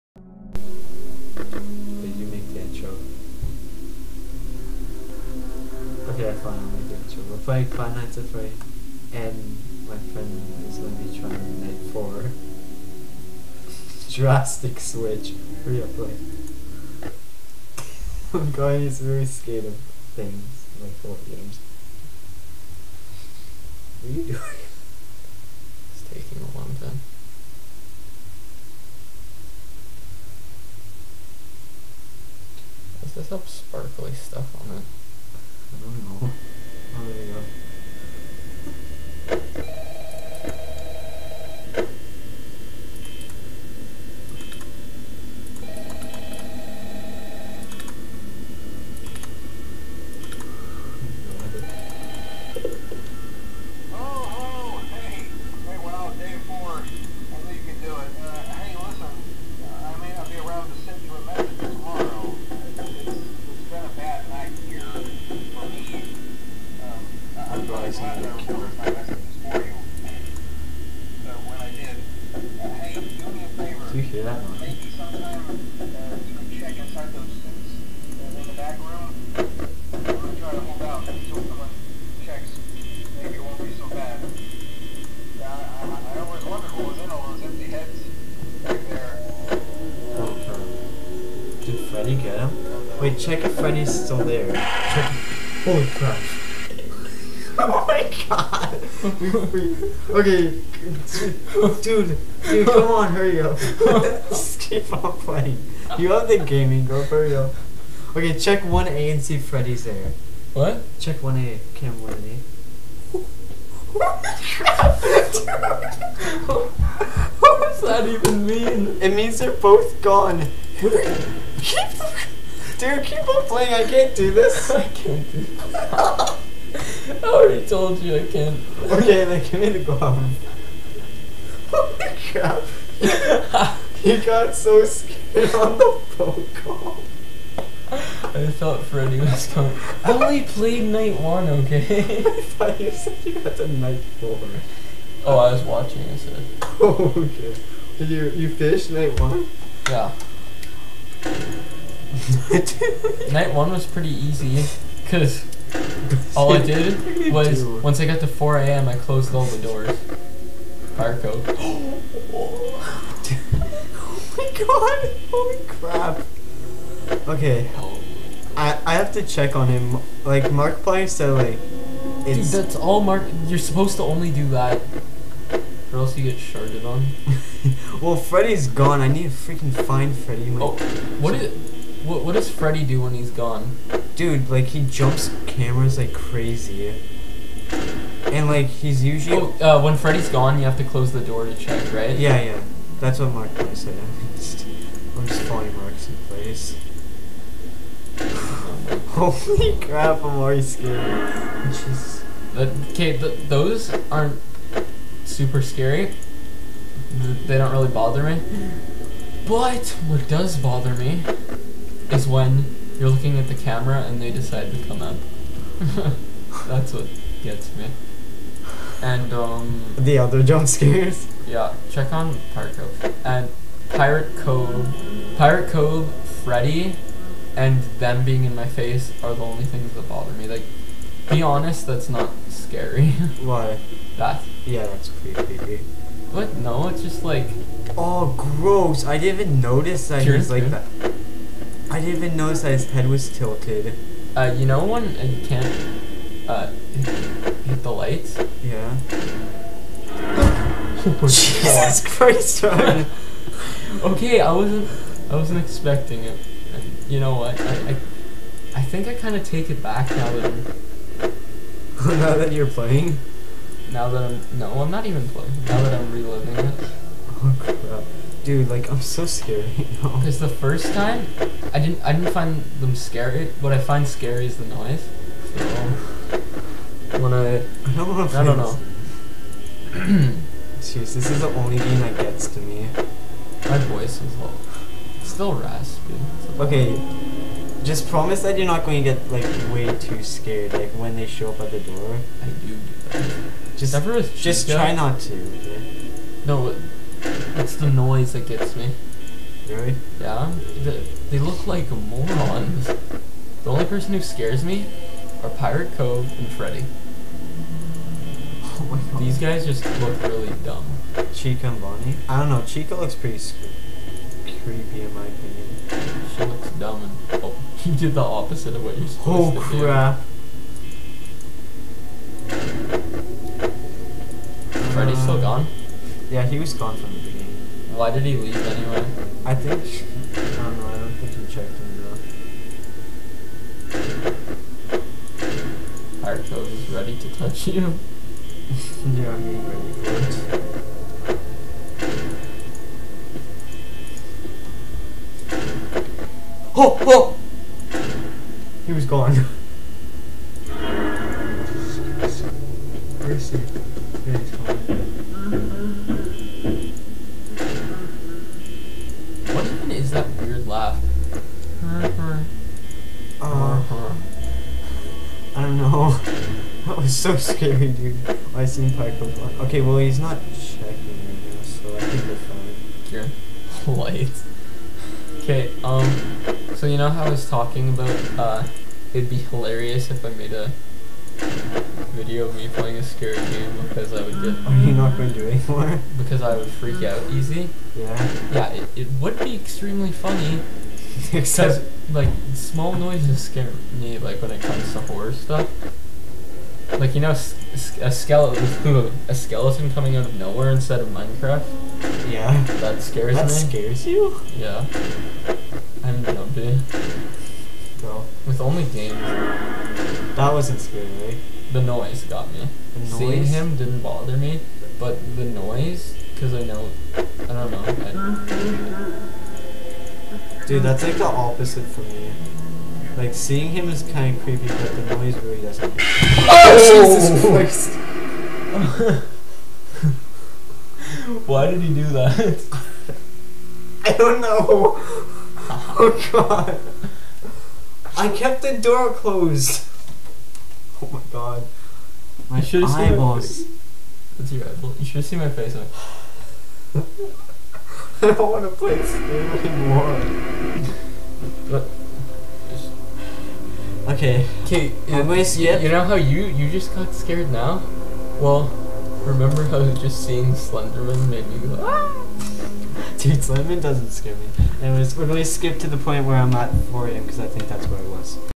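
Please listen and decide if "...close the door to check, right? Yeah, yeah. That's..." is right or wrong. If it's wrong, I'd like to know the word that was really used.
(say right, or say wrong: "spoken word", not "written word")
right.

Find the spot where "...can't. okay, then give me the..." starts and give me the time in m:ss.
2:08.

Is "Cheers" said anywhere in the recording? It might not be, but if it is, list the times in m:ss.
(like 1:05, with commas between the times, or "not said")
4:00.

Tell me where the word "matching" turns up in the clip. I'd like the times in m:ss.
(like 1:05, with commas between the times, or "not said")
not said.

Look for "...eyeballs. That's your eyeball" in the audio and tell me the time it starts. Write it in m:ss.
7:23.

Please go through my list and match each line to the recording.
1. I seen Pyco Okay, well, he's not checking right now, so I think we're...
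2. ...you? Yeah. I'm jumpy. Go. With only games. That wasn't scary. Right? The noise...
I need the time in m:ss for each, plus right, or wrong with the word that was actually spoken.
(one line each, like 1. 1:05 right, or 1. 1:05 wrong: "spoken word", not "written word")
1. 6:08 right
2. 6:44 right.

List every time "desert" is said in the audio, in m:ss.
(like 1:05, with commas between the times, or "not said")
not said.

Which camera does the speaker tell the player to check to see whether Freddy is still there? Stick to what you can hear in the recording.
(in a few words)
Cam 1A.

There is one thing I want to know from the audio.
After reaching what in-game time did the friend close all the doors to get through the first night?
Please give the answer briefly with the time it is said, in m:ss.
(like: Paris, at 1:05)
4 a.m., at 2:38.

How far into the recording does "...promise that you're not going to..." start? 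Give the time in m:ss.
4:48.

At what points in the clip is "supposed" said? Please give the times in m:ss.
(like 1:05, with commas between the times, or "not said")
2:53, 5:19.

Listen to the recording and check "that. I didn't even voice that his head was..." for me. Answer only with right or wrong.
wrong.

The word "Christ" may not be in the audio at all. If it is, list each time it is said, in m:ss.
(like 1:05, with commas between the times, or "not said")
4:12, 7:07.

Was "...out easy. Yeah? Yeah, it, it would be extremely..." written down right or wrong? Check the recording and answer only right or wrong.
right.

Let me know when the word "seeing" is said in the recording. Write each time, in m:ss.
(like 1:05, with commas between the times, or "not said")
6:53, 7:03, 7:40.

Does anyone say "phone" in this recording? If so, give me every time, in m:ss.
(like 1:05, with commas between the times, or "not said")
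2:16.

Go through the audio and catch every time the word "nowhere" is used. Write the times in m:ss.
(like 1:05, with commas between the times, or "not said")
6:40.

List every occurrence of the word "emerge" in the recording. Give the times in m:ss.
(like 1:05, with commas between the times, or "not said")
not said.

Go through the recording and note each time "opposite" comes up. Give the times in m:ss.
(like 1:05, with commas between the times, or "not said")
5:18, 7:01.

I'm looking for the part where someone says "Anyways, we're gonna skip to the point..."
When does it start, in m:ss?
7:44.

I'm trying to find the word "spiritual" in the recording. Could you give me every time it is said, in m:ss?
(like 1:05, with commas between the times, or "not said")
not said.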